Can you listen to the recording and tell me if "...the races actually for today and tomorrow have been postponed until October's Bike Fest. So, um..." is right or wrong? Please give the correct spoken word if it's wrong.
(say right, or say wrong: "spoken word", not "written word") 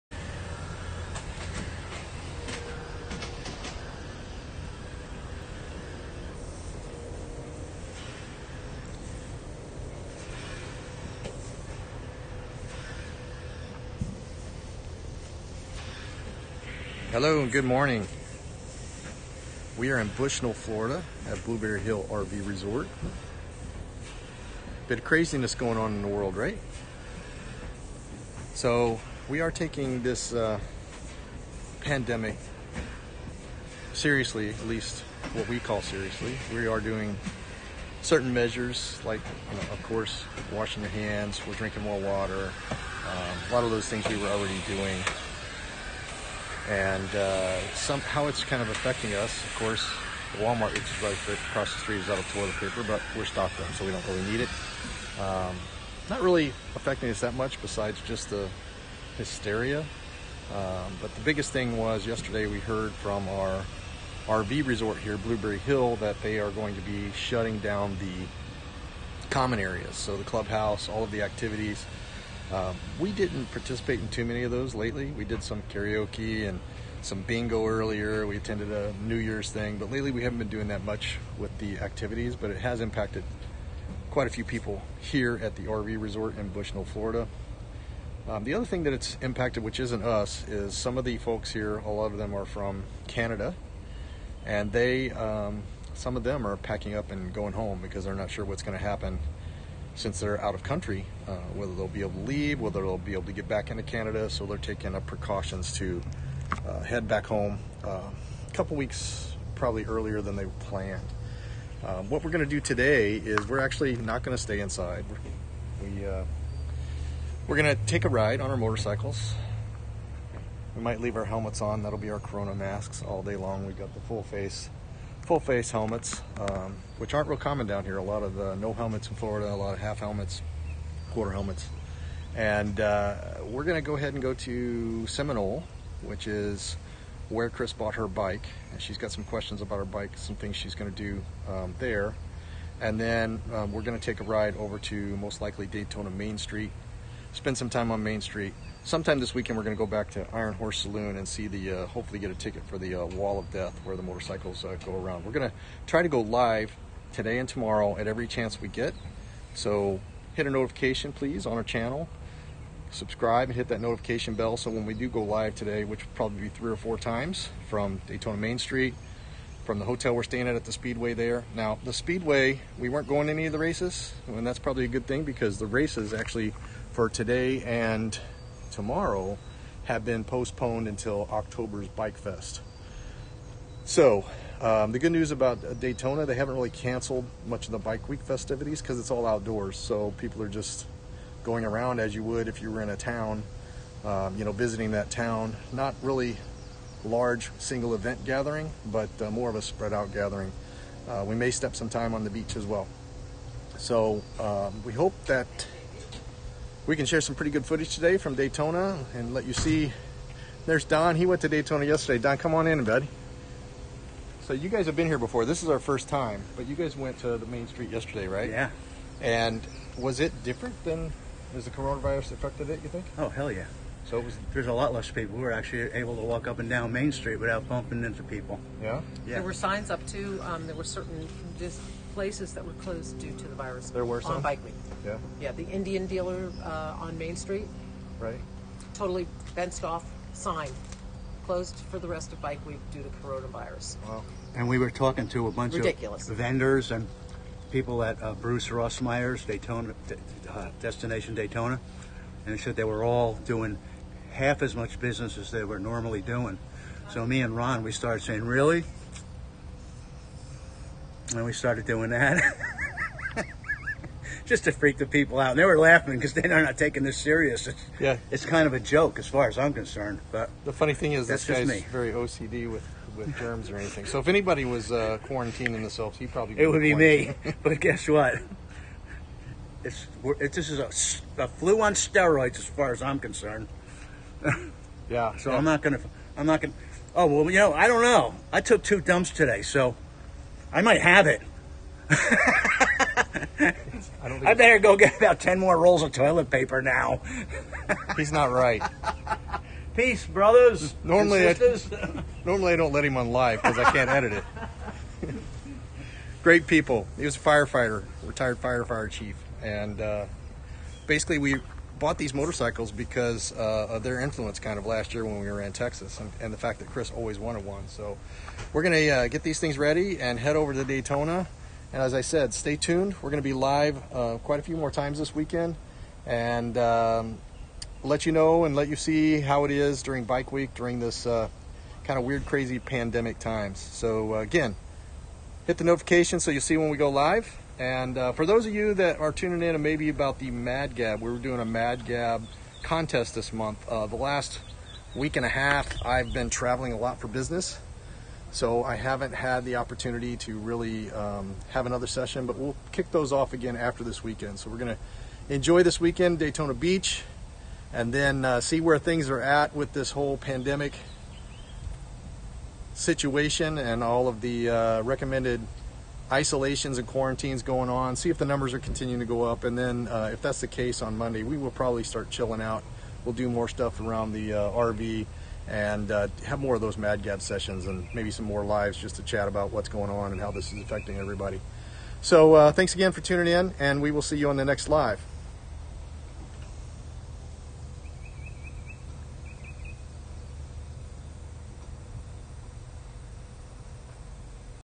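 right.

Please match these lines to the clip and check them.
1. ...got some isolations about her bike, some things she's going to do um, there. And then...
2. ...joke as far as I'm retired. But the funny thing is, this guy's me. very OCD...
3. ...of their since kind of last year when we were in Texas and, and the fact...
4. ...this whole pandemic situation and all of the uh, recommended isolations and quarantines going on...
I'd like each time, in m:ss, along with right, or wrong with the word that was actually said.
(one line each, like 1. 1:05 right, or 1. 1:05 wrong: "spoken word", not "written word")
1. 2:18 wrong: "questions", not "isolations"
2. 4:28 wrong: "concerned", not "retired"
3. 5:13 wrong: "influence", not "since"
4. 5:59 right.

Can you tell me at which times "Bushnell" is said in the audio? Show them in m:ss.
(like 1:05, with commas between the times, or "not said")
0:20, 1:26.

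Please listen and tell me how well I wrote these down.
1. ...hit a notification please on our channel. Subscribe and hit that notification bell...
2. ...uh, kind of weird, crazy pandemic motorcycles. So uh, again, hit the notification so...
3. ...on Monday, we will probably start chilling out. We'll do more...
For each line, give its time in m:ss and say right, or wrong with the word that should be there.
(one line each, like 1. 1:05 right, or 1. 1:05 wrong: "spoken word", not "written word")
1. 2:40 right
2. 5:31 wrong: "times", not "motorcycles"
3. 6:11 right.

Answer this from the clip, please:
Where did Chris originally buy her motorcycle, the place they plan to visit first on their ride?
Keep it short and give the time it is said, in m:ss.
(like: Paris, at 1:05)
Seminole, at 2:15.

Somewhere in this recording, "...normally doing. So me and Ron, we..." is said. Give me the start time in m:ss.
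4:15.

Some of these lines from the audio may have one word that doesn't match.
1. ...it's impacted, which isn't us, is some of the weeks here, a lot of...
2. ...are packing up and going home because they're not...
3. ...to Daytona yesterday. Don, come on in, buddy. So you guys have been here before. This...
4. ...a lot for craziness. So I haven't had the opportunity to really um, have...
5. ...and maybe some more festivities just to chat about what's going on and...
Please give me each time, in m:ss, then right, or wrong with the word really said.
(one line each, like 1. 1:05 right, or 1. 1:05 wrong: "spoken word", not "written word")
1. 1:28 wrong: "folks", not "weeks"
2. 1:36 right
3. 3:31 right
4. 5:46 wrong: "business", not "craziness"
5. 6:17 wrong: "lives", not "festivities".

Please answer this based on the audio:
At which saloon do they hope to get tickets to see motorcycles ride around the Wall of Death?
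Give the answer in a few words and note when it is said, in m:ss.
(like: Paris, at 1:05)
Iron Horse Saloon, at 2:30.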